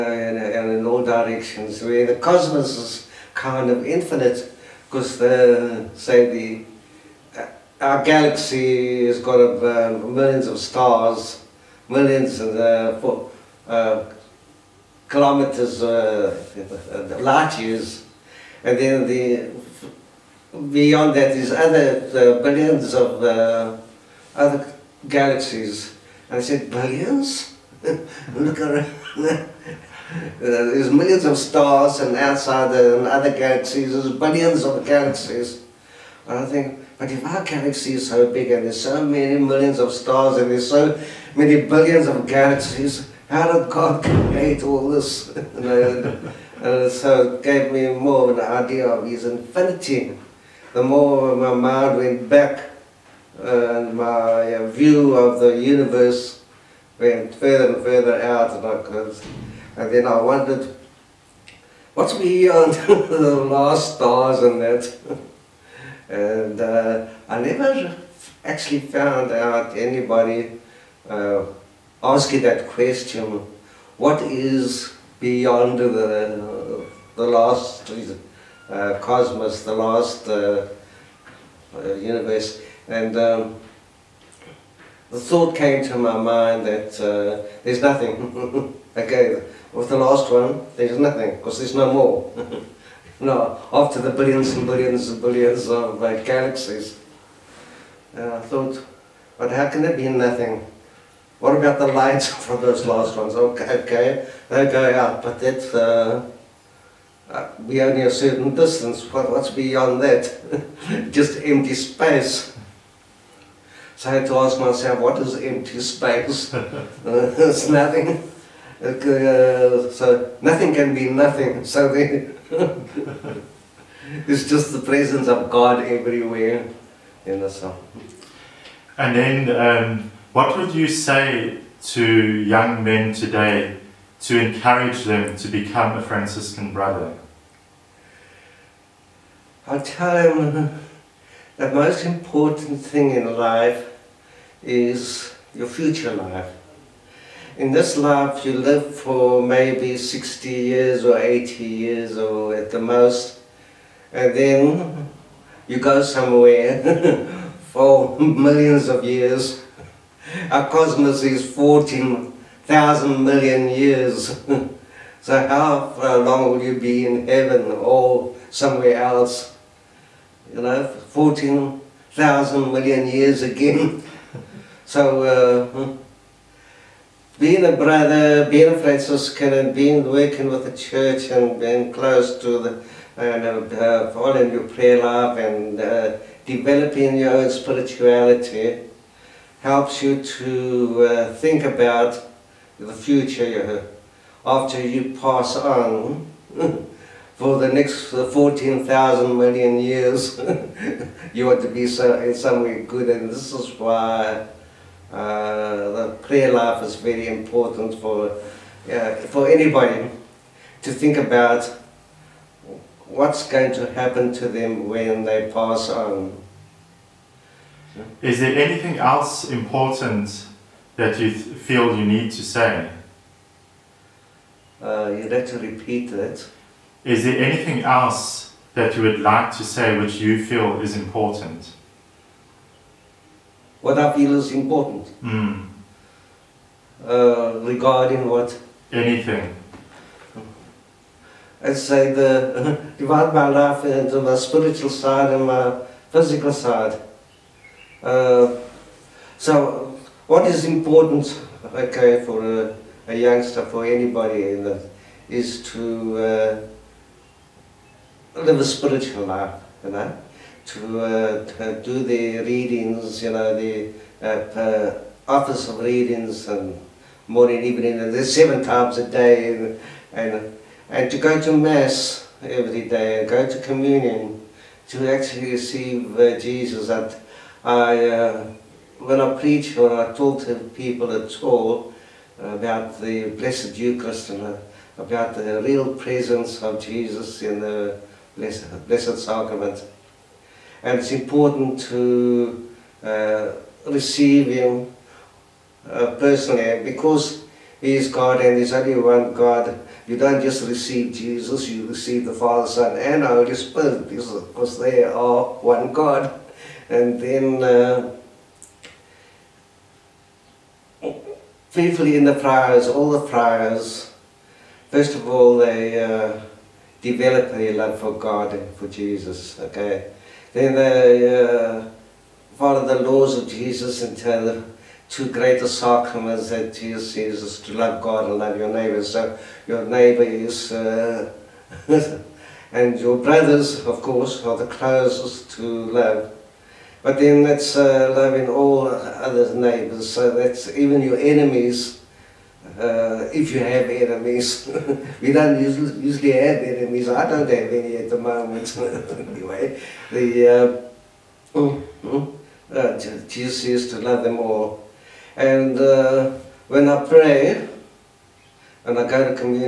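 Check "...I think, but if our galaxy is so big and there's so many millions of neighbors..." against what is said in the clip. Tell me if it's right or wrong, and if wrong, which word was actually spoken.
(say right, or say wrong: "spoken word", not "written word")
wrong: "stars", not "neighbors".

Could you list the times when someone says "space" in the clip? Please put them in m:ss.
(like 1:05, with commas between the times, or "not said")
1:51, 1:55.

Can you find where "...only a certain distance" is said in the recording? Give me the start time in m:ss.
1:47.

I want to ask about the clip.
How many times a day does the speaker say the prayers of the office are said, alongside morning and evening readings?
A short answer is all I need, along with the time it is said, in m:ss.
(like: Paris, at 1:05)
7, at 4:28.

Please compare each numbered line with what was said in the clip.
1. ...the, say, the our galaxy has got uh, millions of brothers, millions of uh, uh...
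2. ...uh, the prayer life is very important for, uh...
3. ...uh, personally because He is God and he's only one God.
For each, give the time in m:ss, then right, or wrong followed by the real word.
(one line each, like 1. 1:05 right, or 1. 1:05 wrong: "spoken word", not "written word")
1. 0:05 wrong: "stars", not "brothers"
2. 3:25 right
3. 4:55 right.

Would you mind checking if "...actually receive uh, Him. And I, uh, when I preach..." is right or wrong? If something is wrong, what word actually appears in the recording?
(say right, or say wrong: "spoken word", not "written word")
wrong: "Jesus", not "Him".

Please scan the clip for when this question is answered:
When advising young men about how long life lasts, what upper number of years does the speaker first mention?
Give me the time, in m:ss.
2:31.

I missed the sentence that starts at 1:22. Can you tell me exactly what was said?
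And um, the thought came to my mind that uh, there's nothing.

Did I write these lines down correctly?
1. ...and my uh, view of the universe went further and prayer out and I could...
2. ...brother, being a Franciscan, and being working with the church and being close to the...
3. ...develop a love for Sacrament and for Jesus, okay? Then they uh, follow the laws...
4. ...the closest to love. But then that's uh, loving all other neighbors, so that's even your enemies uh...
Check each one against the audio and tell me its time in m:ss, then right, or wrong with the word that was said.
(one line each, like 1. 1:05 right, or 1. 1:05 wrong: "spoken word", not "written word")
1. 0:53 wrong: "further", not "prayer"
2. 2:57 right
3. 5:17 wrong: "God", not "Sacrament"
4. 5:34 right.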